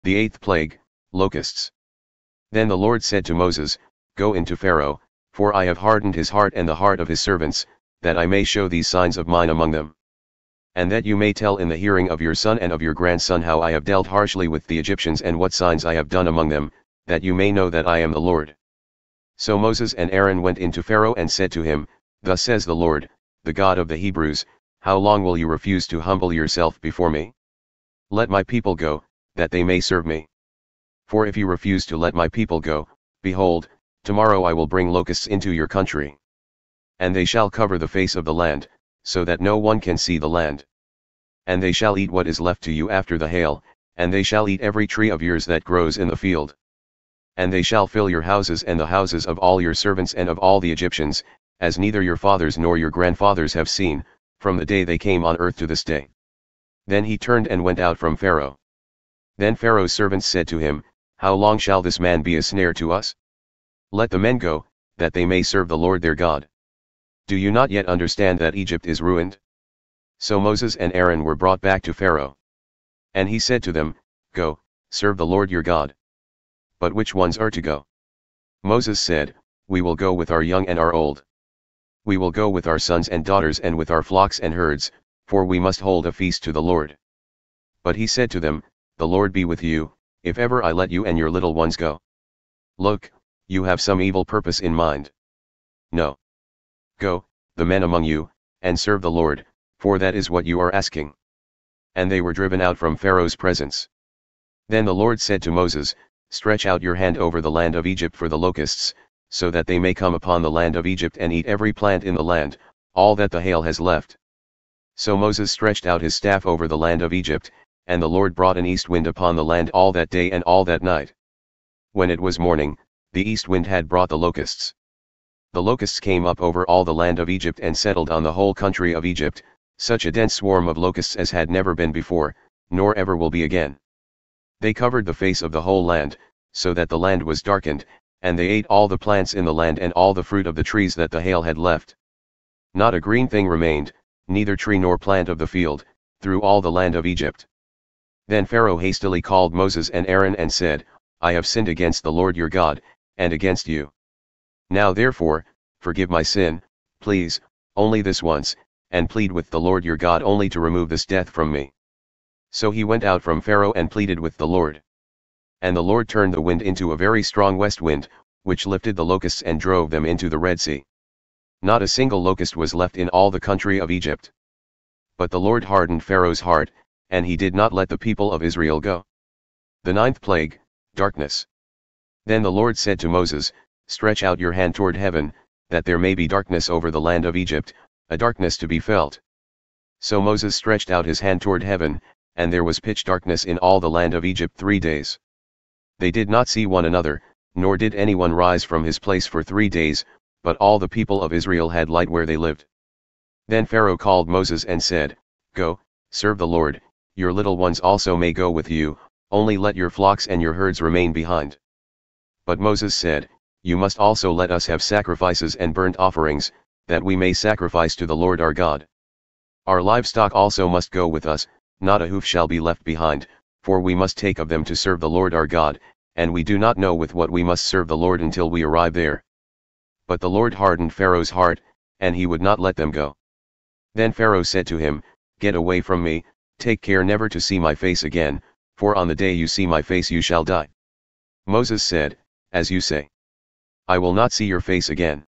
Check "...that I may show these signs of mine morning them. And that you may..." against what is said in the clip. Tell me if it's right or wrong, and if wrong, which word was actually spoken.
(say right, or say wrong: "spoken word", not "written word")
wrong: "among", not "morning".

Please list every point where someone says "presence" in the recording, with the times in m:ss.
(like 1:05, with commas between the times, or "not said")
1:43.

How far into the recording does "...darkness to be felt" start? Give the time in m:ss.
3:08.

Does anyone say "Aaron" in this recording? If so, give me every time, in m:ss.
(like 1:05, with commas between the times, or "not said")
0:20, 1:10, 2:30.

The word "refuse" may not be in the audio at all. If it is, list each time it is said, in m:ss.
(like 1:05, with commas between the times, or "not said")
0:25, 0:31.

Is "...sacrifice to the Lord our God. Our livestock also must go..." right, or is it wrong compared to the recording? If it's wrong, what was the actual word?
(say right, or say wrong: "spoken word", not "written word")
right.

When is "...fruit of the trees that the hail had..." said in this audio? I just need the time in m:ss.
2:20.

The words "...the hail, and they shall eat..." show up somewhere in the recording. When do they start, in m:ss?
0:43.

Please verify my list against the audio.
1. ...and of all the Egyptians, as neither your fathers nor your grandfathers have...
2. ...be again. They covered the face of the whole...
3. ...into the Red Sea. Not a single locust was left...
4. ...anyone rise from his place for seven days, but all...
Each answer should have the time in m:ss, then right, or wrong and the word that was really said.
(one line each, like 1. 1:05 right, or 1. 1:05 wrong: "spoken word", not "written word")
1. 0:50 right
2. 2:13 right
3. 2:50 right
4. 3:17 wrong: "three", not "seven".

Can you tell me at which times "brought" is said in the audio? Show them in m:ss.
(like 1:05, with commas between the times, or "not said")
1:11, 1:58, 2:03.